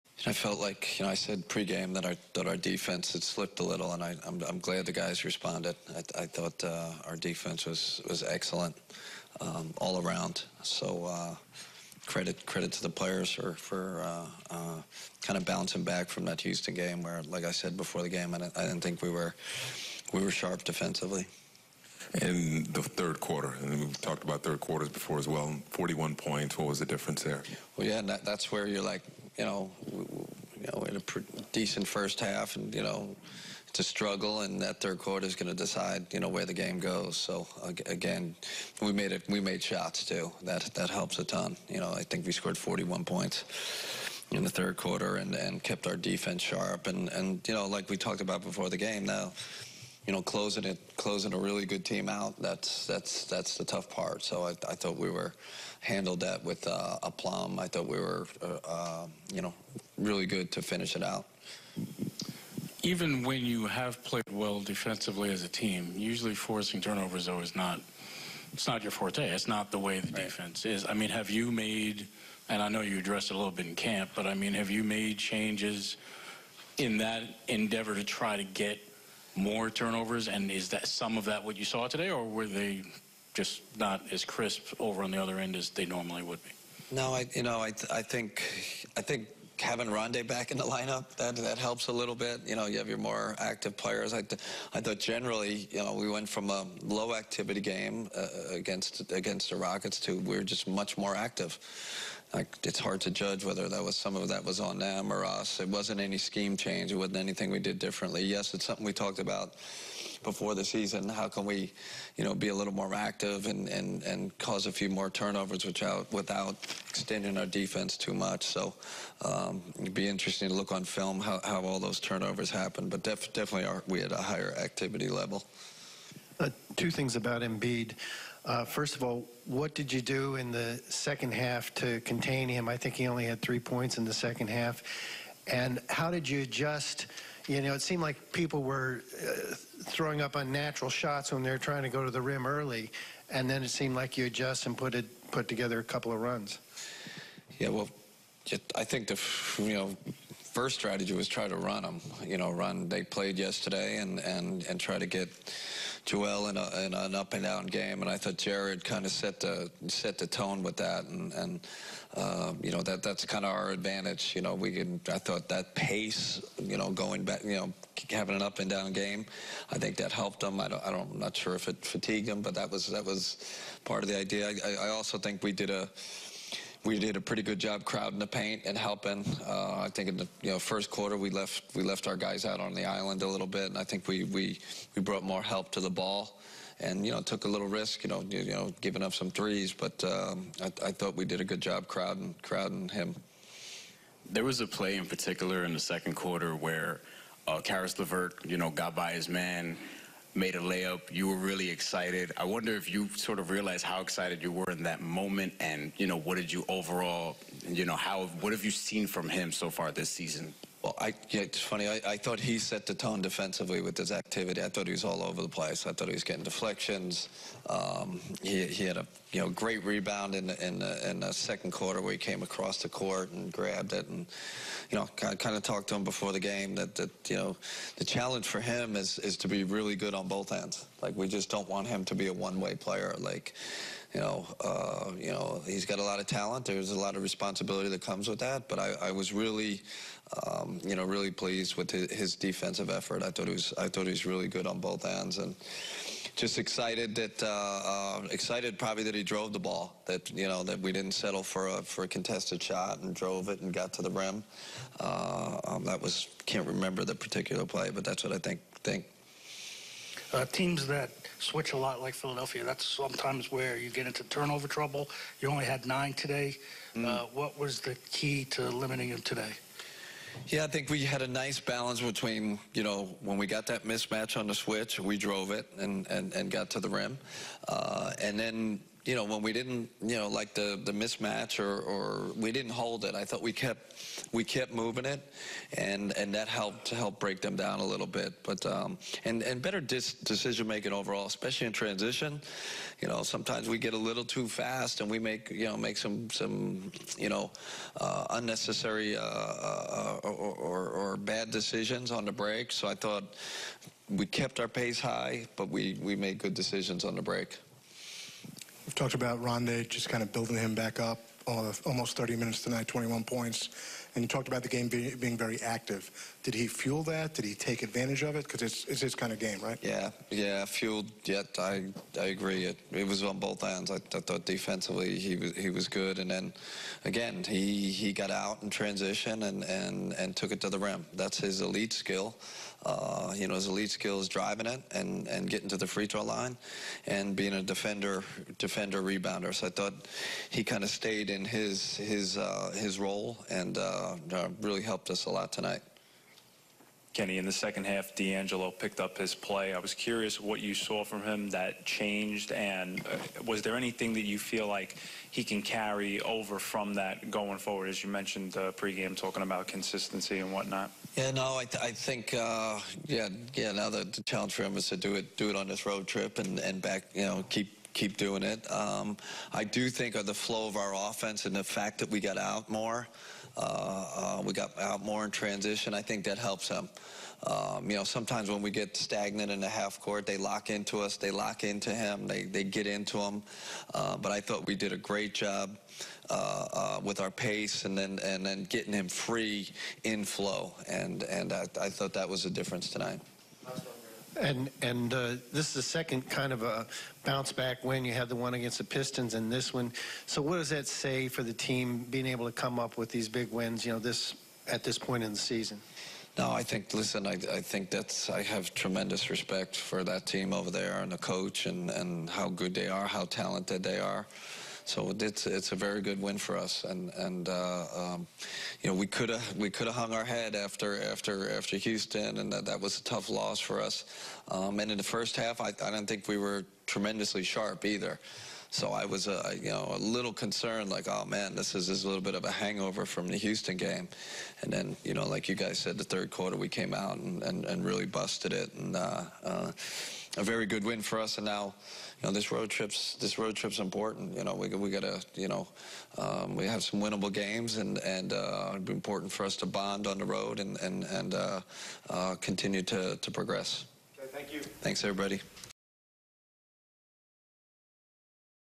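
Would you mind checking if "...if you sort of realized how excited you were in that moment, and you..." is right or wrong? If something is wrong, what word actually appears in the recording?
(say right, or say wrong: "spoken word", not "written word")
right.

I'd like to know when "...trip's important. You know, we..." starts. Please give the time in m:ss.
7:23.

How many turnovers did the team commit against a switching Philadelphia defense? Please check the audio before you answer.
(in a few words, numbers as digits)
9.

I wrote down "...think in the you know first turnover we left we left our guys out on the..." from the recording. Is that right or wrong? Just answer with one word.
wrong.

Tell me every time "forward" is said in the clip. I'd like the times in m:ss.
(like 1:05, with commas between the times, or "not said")
5:57.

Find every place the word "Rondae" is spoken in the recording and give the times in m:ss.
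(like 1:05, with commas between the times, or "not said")
1:29, 5:09.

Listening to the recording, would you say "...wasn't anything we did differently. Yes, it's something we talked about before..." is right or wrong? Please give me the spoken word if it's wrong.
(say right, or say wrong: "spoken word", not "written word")
right.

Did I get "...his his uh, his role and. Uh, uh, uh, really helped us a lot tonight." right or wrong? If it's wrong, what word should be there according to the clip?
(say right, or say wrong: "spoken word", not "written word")
right.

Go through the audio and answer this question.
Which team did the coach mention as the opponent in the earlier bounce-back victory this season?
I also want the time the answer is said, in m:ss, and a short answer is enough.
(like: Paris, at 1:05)
Pistons, at 6:38.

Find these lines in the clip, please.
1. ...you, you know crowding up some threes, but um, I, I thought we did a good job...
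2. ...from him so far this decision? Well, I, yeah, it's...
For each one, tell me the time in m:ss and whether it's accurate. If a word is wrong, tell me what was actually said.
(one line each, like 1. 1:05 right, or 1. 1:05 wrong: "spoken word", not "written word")
1. 3:08 wrong: "giving", not "crowding"
2. 3:29 wrong: "season", not "decision".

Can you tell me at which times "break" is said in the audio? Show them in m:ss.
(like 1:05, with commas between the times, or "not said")
4:47, 5:02, 5:07.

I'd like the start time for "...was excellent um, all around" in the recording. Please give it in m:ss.
0:08.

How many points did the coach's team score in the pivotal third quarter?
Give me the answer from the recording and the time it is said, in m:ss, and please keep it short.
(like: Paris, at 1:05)
41, at 0:42.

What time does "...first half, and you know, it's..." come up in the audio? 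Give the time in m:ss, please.
0:31.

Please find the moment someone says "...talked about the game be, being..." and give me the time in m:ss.
5:14.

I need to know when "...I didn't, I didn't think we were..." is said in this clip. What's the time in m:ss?
0:18.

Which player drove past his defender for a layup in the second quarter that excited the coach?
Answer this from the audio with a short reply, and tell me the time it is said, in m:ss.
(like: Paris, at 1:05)
Caris LeVert, at 3:17.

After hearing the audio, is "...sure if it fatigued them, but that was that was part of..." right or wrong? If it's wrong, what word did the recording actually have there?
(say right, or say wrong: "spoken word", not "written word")
right.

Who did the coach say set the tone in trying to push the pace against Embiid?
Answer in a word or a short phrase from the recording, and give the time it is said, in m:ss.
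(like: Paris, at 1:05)
Jarrett, at 2:38.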